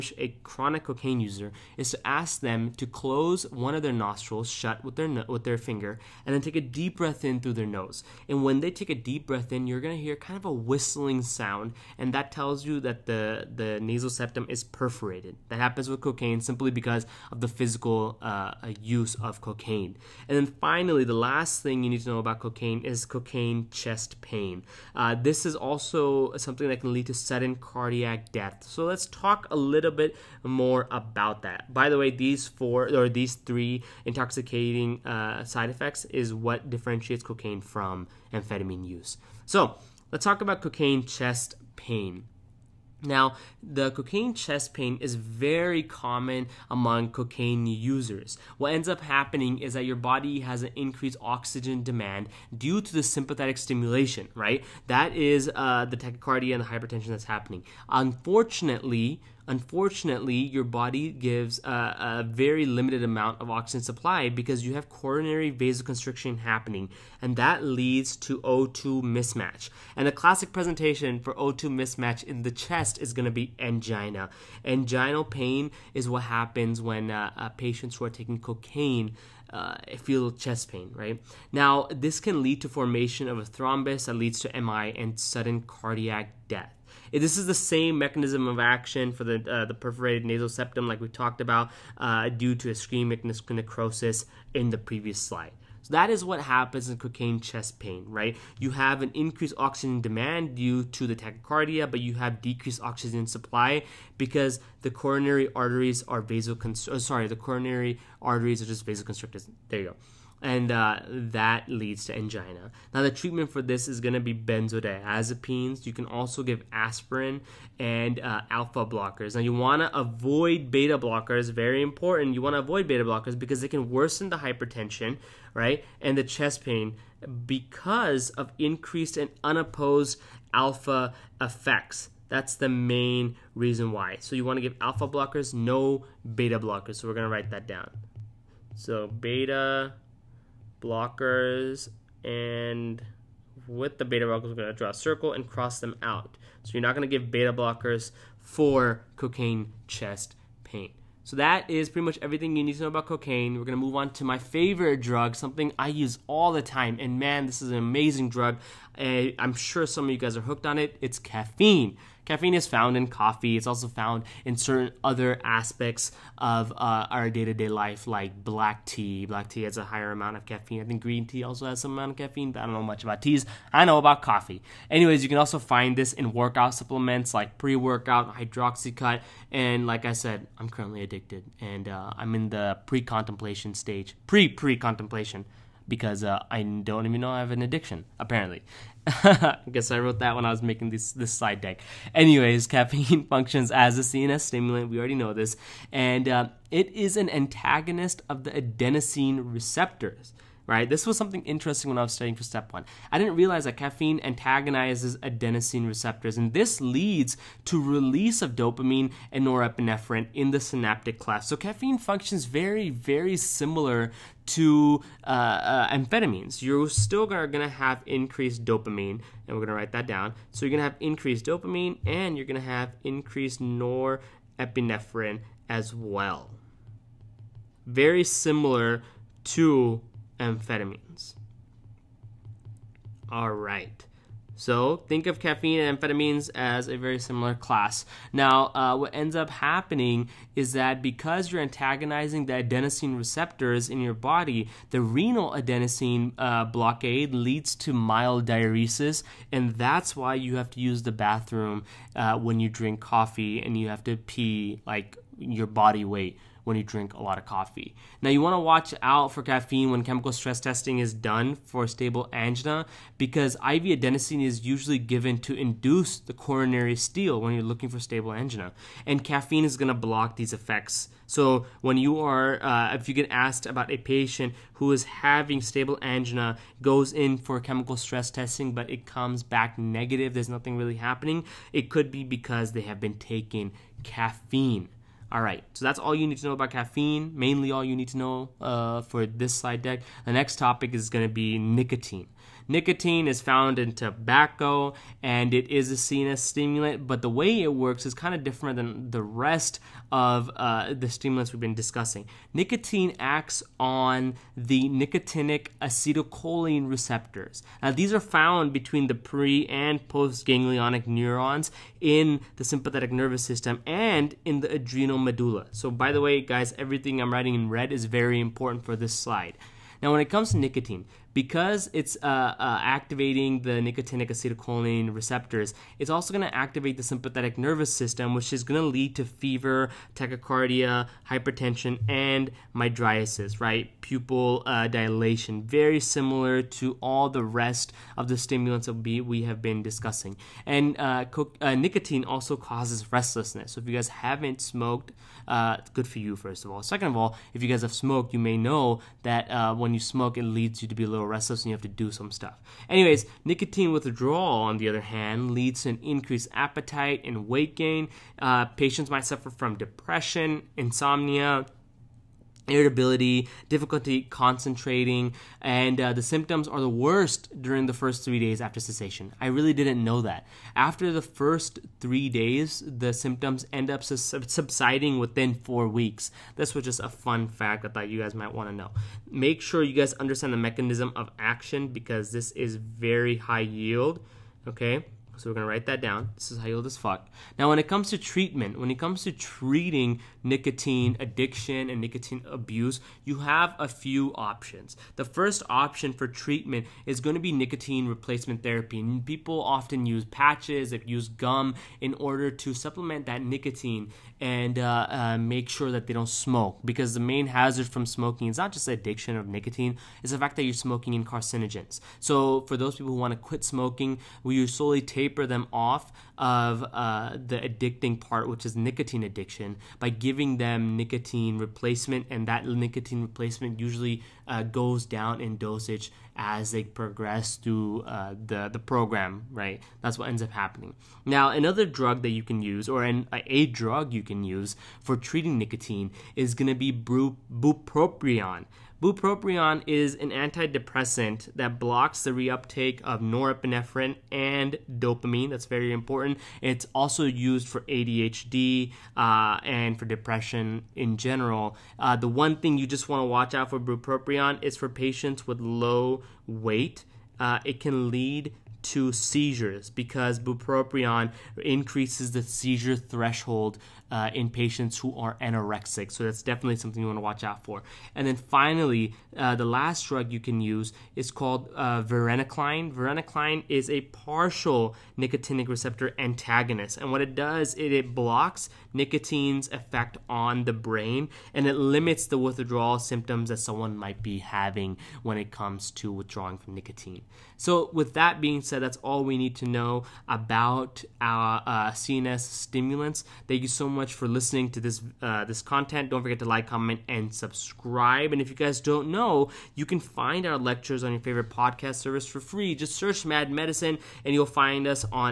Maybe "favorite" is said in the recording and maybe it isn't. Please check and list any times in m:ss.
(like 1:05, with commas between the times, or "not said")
2:34, 8:21.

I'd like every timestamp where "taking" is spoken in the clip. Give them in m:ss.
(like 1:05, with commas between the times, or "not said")
1:18, 4:43.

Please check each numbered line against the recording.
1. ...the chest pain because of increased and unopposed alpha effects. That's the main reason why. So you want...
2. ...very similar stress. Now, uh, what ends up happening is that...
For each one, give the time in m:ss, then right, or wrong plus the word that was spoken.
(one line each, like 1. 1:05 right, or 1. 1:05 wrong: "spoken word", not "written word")
1. 2:06 right
2. 3:56 wrong: "class", not "stress".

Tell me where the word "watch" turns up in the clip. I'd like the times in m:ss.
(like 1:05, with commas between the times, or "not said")
4:18, 7:33, 7:47.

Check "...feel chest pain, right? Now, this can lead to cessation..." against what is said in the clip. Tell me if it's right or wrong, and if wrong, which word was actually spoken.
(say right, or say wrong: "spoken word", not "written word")
wrong: "formation", not "cessation".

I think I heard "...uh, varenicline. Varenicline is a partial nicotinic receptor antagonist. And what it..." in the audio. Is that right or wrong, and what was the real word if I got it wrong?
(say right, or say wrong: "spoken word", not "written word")
right.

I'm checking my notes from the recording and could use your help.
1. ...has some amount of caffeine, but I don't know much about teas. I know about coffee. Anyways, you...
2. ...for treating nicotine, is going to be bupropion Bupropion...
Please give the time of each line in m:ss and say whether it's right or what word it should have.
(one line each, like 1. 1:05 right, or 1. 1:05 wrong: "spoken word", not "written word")
1. 2:51 right
2. 7:15 right.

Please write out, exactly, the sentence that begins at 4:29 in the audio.
And caffeine is going to block these effects.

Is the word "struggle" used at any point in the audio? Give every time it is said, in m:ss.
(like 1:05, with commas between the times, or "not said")
not said.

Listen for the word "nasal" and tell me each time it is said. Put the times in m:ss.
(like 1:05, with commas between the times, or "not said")
0:13, 1:30.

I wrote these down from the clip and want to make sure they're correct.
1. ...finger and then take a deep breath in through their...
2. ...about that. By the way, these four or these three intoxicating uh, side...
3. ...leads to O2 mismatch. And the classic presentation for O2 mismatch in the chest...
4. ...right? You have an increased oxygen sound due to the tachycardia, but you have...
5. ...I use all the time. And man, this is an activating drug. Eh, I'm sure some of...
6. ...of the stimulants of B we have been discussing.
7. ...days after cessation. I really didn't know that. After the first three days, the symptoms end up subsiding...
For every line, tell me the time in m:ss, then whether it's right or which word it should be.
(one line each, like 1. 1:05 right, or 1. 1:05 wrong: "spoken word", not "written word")
1. 0:05 right
2. 0:30 right
3. 1:07 right
4. 1:38 wrong: "demand", not "sound"
5. 2:35 wrong: "amazing", not "activating"
6. 5:38 right
7. 6:08 right.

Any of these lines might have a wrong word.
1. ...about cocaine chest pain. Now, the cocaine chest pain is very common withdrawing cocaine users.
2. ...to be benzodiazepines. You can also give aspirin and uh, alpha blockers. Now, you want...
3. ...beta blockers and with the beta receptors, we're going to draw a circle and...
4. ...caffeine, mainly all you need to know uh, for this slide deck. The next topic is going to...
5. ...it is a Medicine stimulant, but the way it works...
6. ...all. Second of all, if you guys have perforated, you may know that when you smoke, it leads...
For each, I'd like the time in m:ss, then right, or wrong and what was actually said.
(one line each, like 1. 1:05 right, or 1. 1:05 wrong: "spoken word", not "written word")
1. 0:40 wrong: "among", not "withdrawing"
2. 1:54 right
3. 2:19 wrong: "blockers", not "receptors"
4. 4:46 right
5. 4:55 wrong: "CNS", not "Medicine"
6. 5:46 wrong: "smoked", not "perforated".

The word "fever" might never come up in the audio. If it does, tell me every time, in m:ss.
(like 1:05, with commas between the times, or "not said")
5:29.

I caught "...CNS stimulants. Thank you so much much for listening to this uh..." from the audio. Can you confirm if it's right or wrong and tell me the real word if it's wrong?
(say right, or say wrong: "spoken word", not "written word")
right.